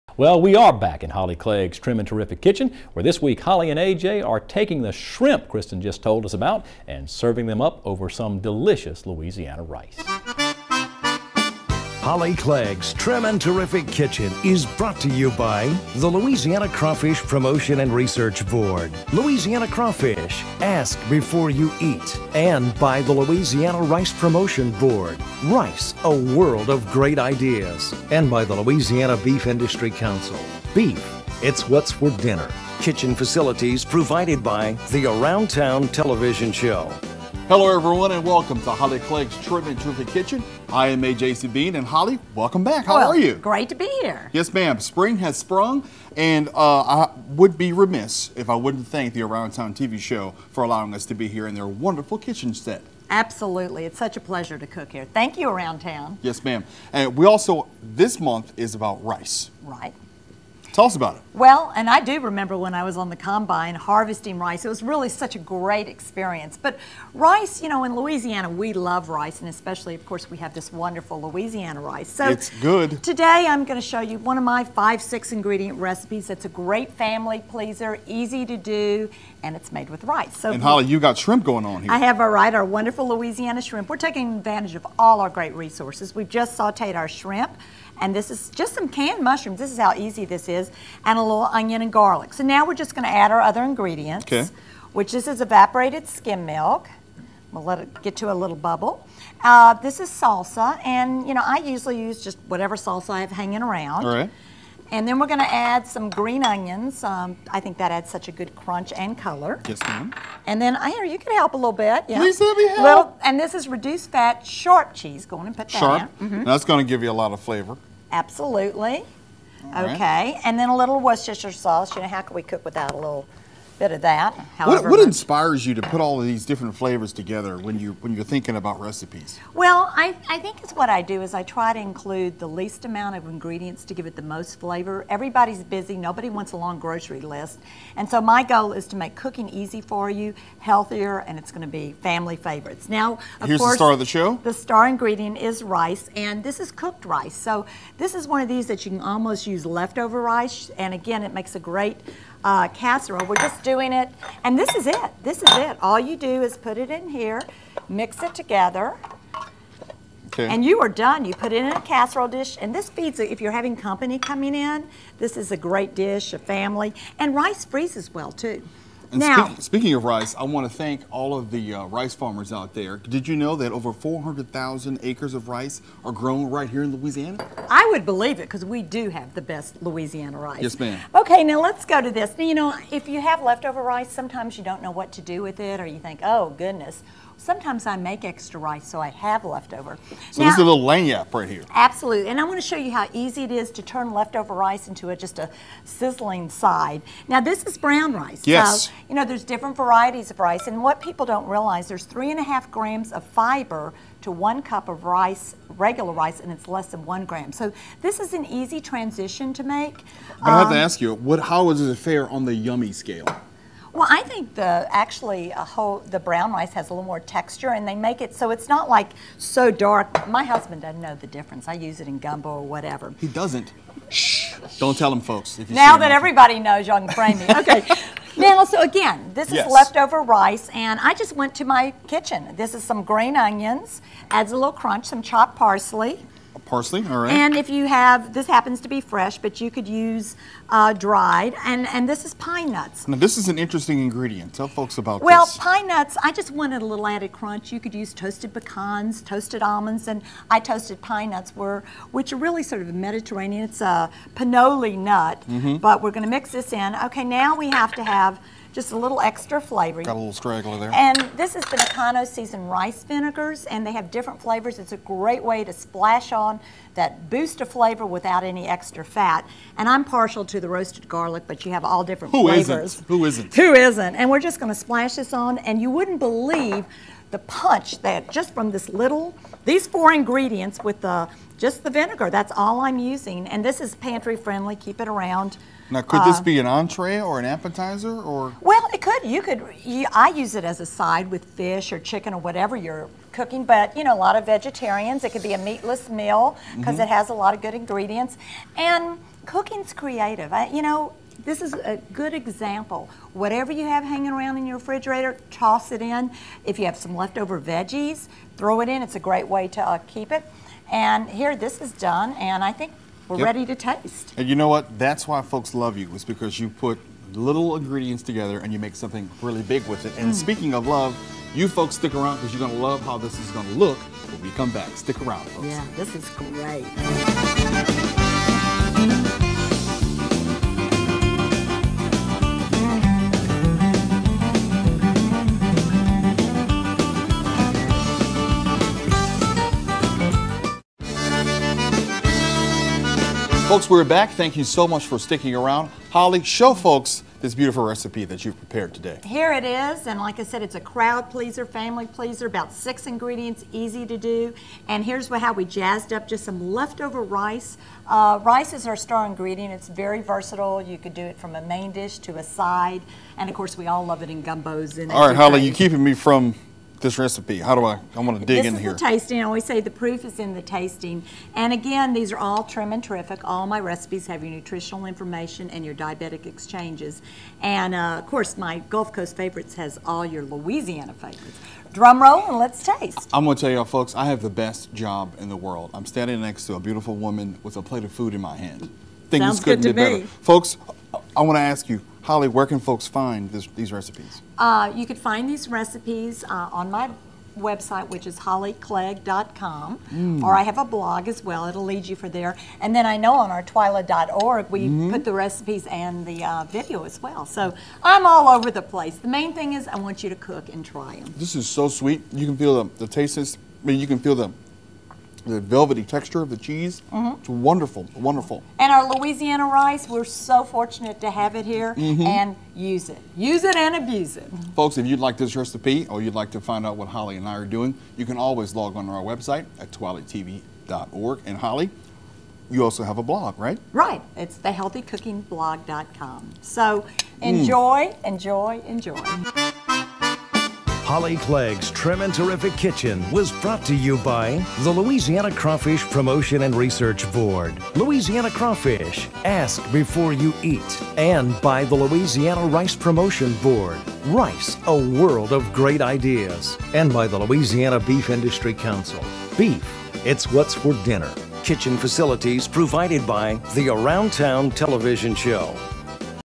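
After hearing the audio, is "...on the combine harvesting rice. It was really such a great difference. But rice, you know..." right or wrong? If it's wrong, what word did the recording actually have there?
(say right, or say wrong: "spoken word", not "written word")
wrong: "experience", not "difference".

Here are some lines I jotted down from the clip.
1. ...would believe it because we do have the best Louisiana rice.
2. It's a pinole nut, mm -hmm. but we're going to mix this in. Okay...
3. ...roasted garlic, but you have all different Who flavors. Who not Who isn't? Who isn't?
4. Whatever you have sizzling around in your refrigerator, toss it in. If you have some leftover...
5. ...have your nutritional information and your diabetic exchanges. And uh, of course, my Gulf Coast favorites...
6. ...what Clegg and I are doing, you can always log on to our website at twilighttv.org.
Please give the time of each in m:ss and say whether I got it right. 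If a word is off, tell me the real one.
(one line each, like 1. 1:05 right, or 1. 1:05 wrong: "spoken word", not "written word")
1. 2:57 right
2. 4:13 right
3. 4:30 right
4. 5:03 wrong: "hanging", not "sizzling"
5. 6:14 right
6. 7:06 wrong: "Holly", not "Clegg".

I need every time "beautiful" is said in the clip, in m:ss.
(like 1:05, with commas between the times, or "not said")
5:47, 6:26.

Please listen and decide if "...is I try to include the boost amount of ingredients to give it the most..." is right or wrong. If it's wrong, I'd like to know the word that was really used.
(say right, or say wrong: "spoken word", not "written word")
wrong: "least", not "boost".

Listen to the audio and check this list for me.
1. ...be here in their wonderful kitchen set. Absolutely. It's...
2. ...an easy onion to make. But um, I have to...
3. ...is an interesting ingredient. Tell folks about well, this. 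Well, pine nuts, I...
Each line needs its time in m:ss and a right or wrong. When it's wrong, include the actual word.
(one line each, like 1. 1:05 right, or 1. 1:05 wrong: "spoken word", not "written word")
1. 0:51 right
2. 3:28 wrong: "transition", not "onion"
3. 4:03 right.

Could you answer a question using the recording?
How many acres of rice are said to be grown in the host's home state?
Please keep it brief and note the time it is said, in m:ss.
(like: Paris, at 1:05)
400,000, at 2:53.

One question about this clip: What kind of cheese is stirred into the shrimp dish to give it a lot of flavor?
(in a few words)
reduced fat sharp cheese.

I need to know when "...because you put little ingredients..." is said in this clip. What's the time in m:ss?
5:16.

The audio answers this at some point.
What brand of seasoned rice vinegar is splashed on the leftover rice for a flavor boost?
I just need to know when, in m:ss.
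4:21.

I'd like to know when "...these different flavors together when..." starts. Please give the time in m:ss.
2:06.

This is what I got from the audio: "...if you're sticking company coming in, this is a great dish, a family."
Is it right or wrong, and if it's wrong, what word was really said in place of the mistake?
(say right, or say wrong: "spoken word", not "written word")
wrong: "having", not "sticking".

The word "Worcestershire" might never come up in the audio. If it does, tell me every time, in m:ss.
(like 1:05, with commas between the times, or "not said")
2:00.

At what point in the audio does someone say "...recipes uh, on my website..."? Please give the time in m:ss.
6:35.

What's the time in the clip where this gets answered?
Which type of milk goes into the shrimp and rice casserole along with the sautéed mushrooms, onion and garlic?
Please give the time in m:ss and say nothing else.
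1:35.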